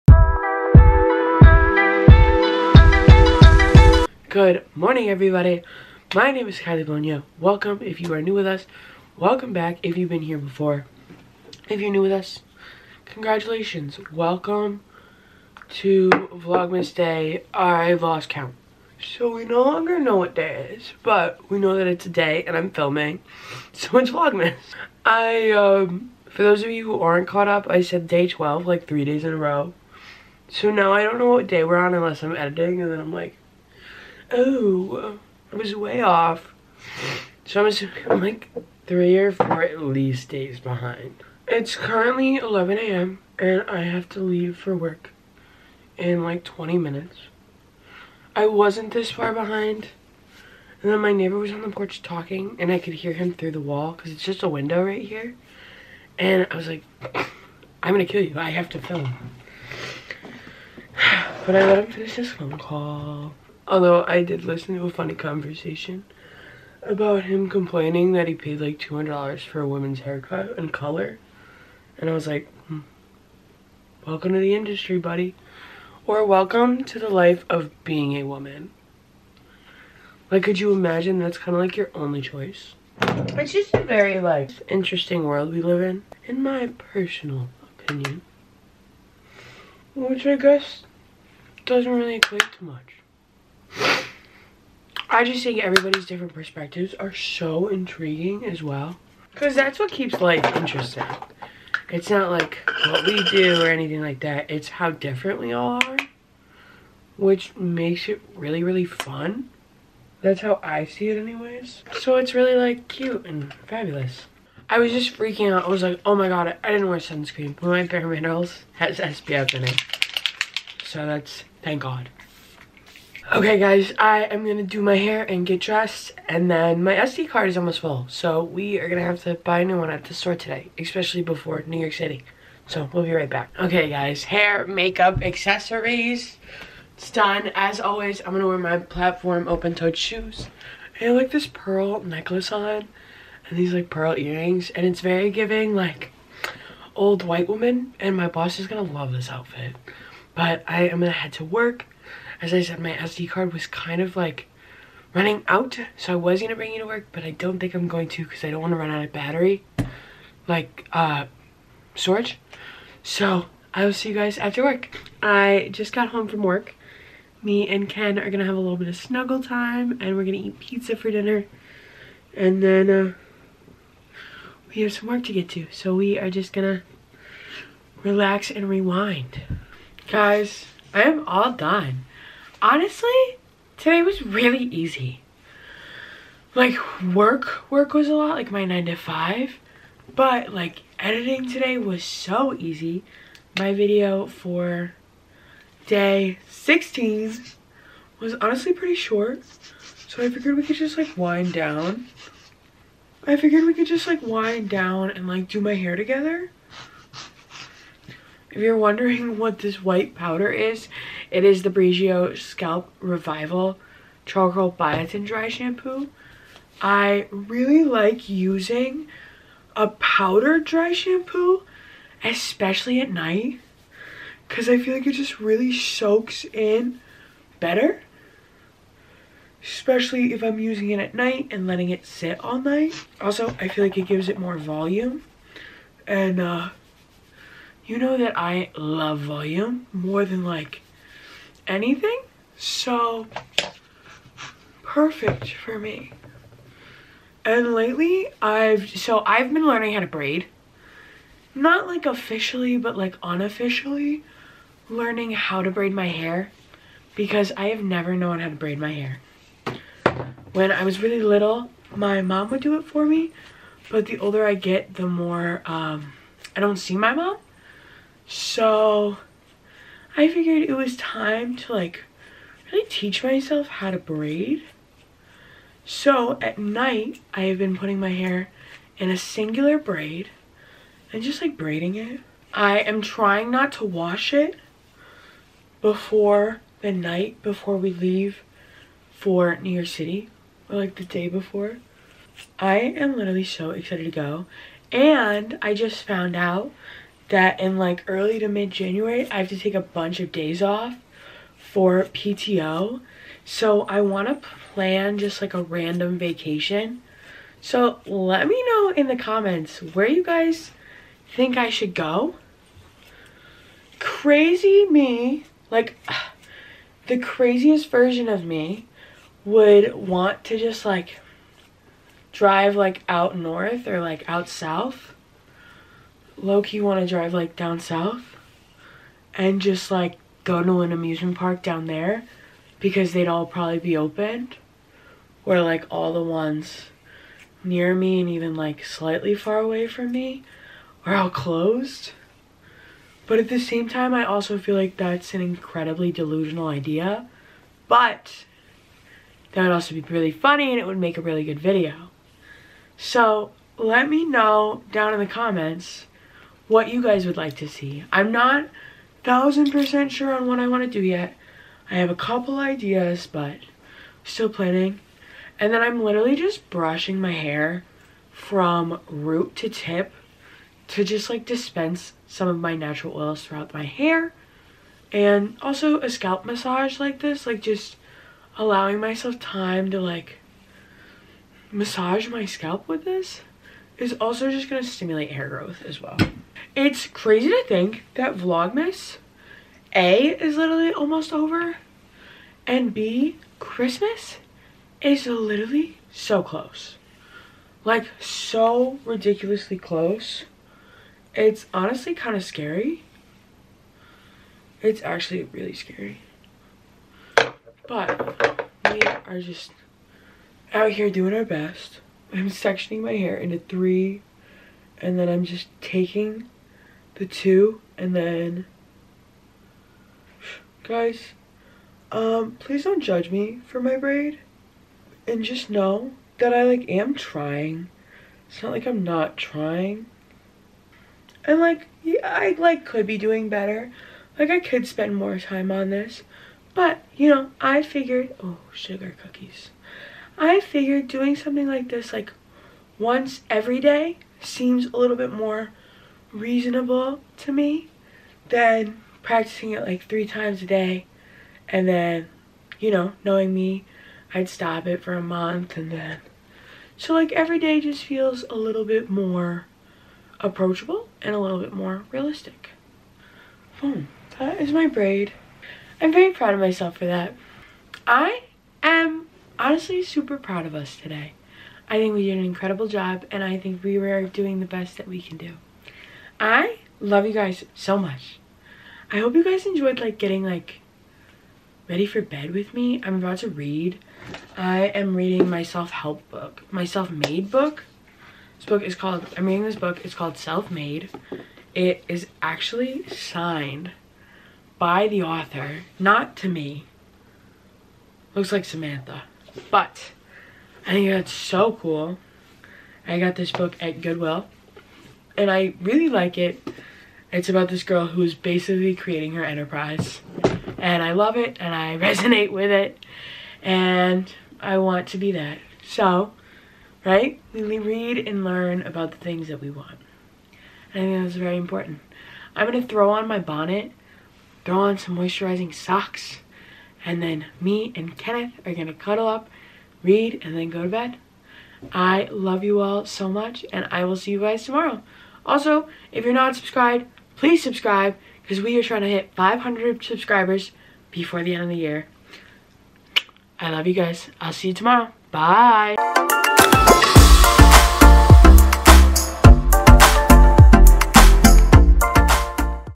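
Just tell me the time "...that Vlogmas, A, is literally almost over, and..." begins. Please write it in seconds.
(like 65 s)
388 s.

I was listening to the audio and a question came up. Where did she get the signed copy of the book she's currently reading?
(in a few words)
Goodwill.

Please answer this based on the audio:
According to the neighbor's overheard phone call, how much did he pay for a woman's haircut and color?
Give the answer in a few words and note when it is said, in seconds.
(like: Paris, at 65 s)
$200, at 68 s.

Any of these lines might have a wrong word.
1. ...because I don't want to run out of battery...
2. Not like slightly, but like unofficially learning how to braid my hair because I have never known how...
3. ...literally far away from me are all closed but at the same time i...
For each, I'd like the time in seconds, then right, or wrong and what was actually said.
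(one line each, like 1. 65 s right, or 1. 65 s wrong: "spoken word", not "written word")
1. 158 s right
2. 251 s wrong: "officially", not "slightly"
3. 338 s wrong: "slightly", not "literally".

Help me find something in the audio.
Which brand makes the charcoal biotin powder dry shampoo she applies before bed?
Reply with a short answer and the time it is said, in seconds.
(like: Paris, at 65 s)
Briogeo, at 211 s.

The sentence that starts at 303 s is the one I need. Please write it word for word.
So I want to plan just like a random vacation.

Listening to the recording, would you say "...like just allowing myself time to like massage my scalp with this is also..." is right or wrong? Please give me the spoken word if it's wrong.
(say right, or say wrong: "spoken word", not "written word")
right.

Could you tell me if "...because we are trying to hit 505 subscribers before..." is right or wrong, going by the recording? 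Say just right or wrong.
wrong.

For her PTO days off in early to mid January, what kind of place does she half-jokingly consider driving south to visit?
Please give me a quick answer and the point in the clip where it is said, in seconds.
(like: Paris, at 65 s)
Amusement park, at 330 s.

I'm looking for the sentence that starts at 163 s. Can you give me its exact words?
So I will see you guys after work.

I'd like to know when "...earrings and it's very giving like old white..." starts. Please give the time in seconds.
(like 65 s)
144 s.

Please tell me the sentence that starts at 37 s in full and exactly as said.
So I'm like three or four at least days behind.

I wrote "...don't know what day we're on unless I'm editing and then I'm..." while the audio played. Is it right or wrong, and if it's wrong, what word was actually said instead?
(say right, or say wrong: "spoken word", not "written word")
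right.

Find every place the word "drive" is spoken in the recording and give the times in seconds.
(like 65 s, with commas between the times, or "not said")
322 s, 327 s.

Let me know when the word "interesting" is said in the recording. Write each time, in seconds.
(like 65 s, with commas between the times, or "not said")
84 s, 100 s.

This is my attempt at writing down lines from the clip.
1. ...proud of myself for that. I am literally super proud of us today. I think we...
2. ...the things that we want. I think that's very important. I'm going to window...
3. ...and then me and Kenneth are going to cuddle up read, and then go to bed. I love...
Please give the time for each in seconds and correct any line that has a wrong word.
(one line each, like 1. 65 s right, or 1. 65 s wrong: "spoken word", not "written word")
1. 466 s wrong: "honestly", not "literally"
2. 519 s wrong: "throw", not "window"
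3. 527 s right.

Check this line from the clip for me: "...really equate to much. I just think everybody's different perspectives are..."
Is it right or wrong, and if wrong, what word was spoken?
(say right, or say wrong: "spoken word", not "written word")
right.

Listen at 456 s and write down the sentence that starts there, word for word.
So like every day just feels a little bit more approachable and a little bit more realistic.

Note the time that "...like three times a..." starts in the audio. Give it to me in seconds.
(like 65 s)
449 s.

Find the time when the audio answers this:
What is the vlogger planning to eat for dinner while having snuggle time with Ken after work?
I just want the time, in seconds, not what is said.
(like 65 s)
170 s.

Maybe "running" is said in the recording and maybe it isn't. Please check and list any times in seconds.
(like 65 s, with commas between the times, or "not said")
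155 s.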